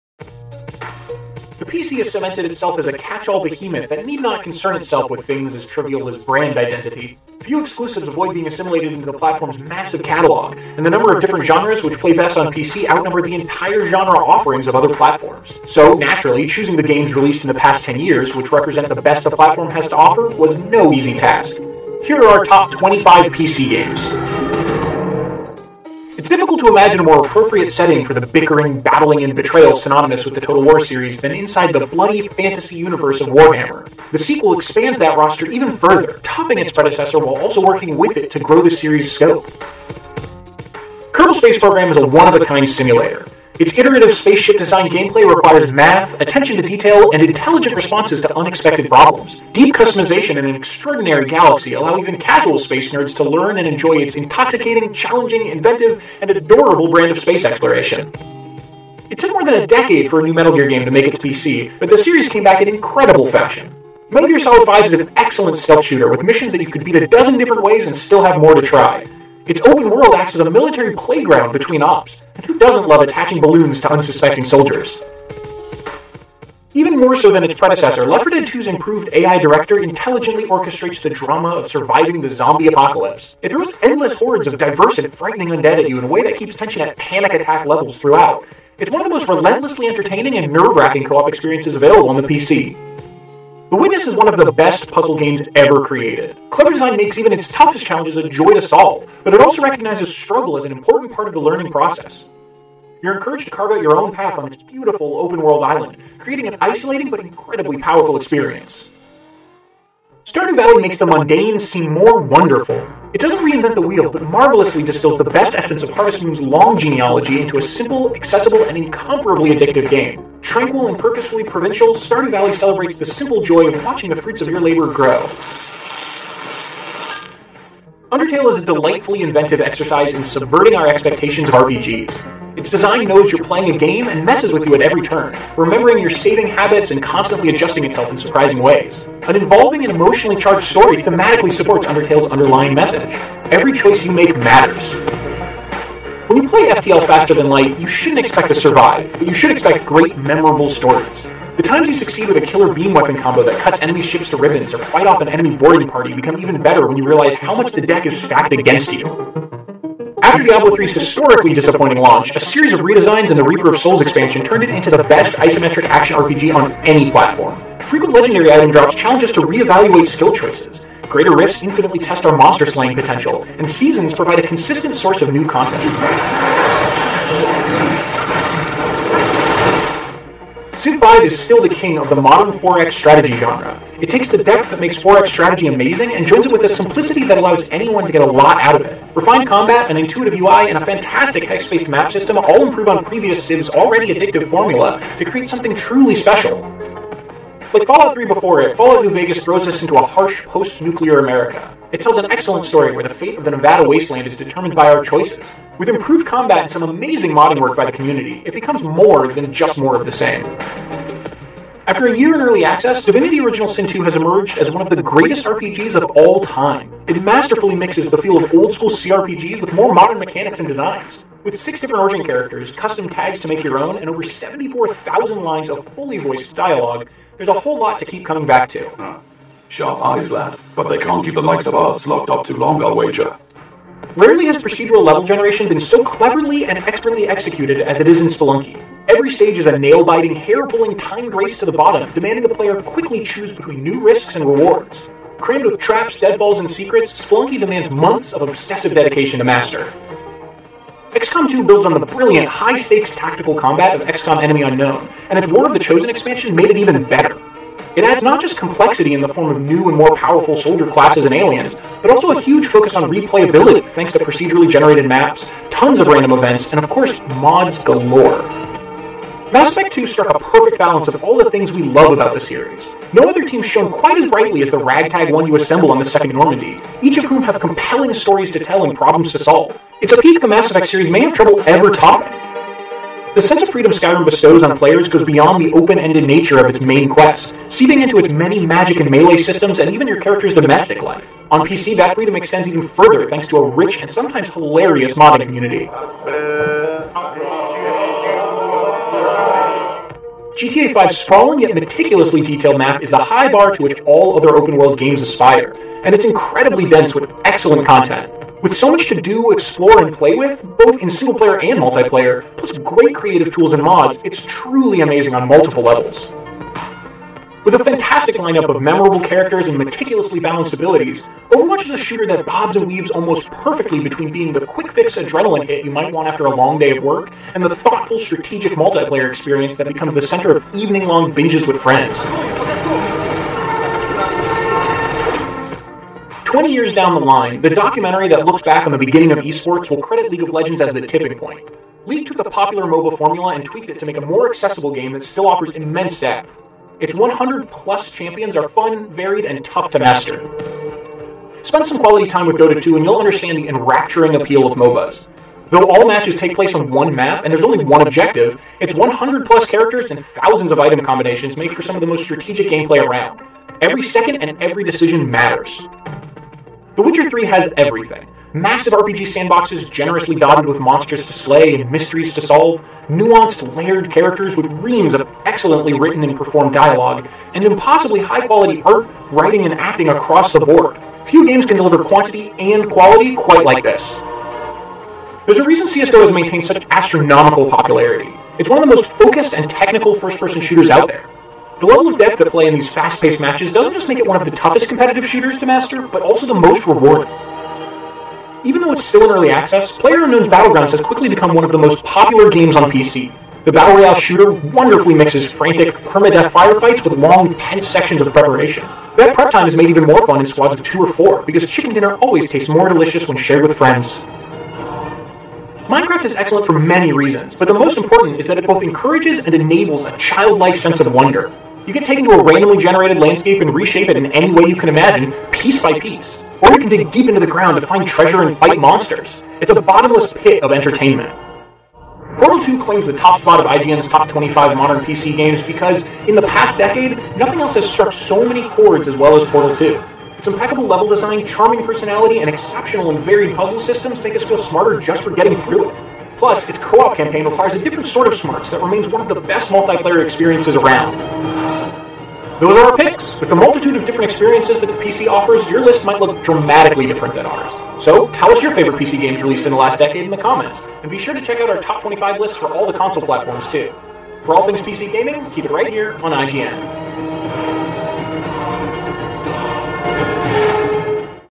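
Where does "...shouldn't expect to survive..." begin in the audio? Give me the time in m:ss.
2:27.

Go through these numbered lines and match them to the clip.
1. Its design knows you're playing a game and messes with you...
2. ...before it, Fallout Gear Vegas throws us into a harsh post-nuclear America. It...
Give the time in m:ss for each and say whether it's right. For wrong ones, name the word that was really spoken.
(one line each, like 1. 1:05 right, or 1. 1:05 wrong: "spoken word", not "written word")
1. 2:12 right
2. 3:18 wrong: "New", not "Gear".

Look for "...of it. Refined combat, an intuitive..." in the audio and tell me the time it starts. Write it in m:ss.
3:08.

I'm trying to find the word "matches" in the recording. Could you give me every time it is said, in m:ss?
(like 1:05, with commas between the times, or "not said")
5:56, 6:33.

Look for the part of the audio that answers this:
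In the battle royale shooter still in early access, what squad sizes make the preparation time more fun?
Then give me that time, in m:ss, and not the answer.
6:50.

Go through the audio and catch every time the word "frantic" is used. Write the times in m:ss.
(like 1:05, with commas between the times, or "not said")
6:45.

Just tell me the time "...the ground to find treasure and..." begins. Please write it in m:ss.
7:07.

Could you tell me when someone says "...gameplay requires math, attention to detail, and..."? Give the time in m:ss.
0:44.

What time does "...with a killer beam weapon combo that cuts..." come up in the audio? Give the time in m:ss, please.
2:32.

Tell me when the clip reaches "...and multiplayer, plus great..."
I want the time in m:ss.
5:11.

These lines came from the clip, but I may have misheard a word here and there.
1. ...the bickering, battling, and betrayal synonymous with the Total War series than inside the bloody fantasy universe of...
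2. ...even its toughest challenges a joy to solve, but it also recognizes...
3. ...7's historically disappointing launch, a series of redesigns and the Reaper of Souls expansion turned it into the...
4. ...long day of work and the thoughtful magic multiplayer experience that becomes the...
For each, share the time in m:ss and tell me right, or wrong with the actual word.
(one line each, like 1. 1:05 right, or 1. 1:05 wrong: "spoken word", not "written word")
1. 0:28 right
2. 1:37 right
3. 2:40 wrong: "3", not "7"
4. 5:26 wrong: "strategic", not "magic".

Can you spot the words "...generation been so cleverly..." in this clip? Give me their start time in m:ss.
3:55.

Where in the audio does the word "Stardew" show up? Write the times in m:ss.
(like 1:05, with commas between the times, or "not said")
1:50, 2:01.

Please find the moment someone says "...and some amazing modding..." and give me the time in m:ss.
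3:26.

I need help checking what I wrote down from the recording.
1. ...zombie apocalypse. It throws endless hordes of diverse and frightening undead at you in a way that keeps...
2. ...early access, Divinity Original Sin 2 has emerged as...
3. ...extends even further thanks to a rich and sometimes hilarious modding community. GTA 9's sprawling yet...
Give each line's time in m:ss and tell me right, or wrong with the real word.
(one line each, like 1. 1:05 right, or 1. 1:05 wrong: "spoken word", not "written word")
1. 1:22 right
2. 3:32 right
3. 4:52 wrong: "5", not "9".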